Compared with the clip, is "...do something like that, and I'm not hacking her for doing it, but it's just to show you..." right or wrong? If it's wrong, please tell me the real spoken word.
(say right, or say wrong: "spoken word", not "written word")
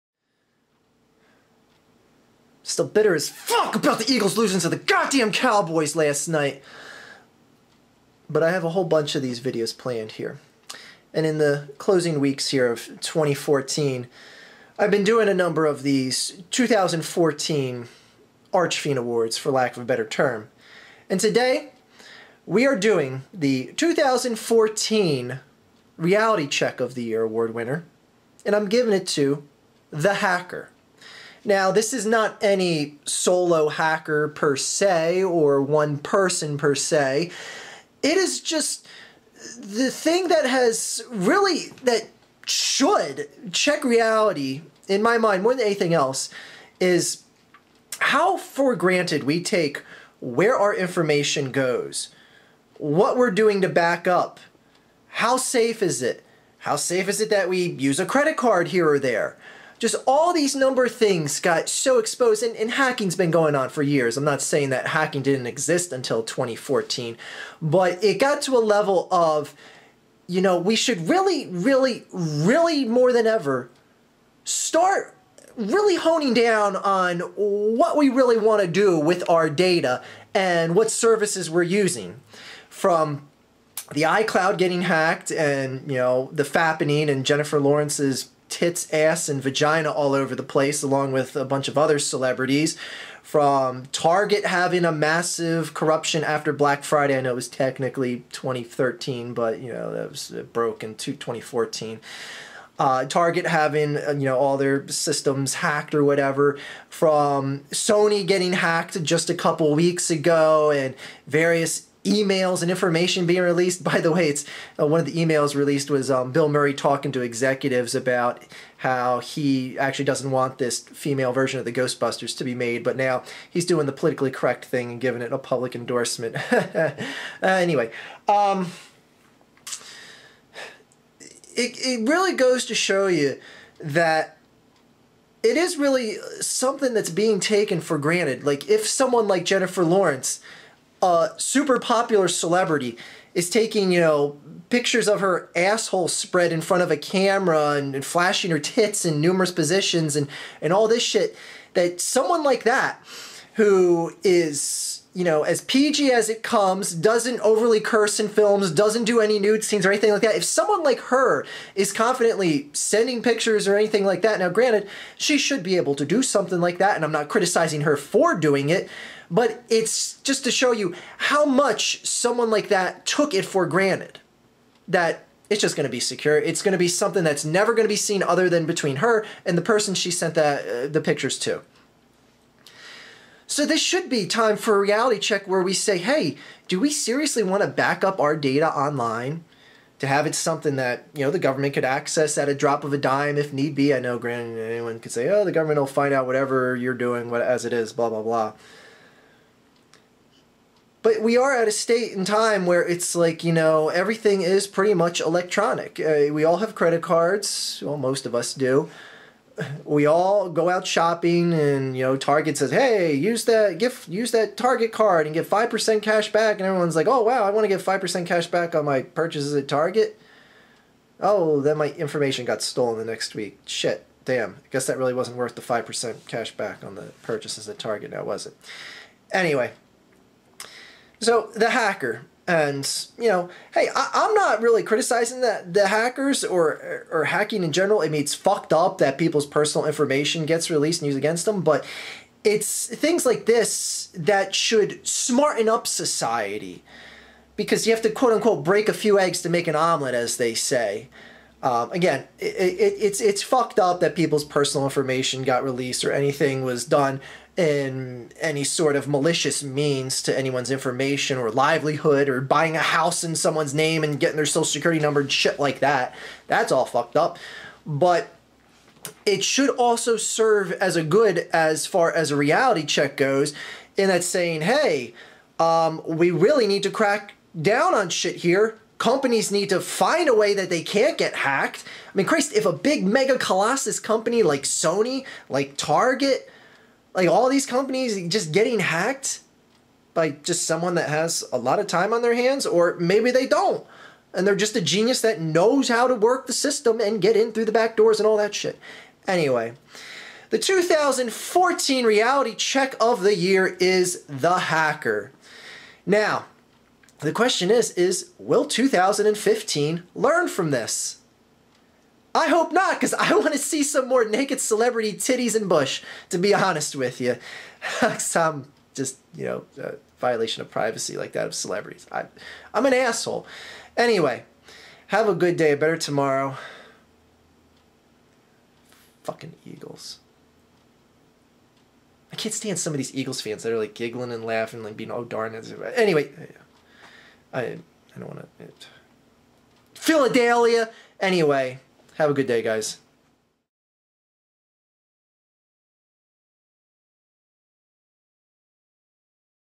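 wrong: "criticizing", not "hacking".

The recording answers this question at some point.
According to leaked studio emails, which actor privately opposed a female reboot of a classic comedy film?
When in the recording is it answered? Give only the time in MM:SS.
01:56.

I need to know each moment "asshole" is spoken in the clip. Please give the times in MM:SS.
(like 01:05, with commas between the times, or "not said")
02:25, 05:22.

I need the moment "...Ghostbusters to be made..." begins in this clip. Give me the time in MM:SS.
02:01.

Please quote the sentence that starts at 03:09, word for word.
To have it something that you know the government could access at a drop of a dime if need be.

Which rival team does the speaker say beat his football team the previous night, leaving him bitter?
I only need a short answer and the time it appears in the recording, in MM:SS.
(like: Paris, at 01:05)
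Cowboys, at 00:05.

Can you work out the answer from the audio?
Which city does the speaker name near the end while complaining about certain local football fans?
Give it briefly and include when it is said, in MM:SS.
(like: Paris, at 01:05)
Philadelphia, at 05:39.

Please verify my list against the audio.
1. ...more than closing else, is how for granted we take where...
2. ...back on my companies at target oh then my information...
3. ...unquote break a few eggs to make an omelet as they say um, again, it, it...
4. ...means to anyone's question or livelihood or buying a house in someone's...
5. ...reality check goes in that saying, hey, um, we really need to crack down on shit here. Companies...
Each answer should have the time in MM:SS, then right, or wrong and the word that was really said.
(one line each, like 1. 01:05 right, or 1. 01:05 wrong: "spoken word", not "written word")
1. 00:45 wrong: "anything", not "closing"
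2. 03:38 wrong: "purchases", not "companies"
3. 04:08 right
4. 04:19 wrong: "information", not "question"
5. 04:32 right.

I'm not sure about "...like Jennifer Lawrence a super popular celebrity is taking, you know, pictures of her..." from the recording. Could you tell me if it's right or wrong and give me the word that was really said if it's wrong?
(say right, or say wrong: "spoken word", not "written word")
right.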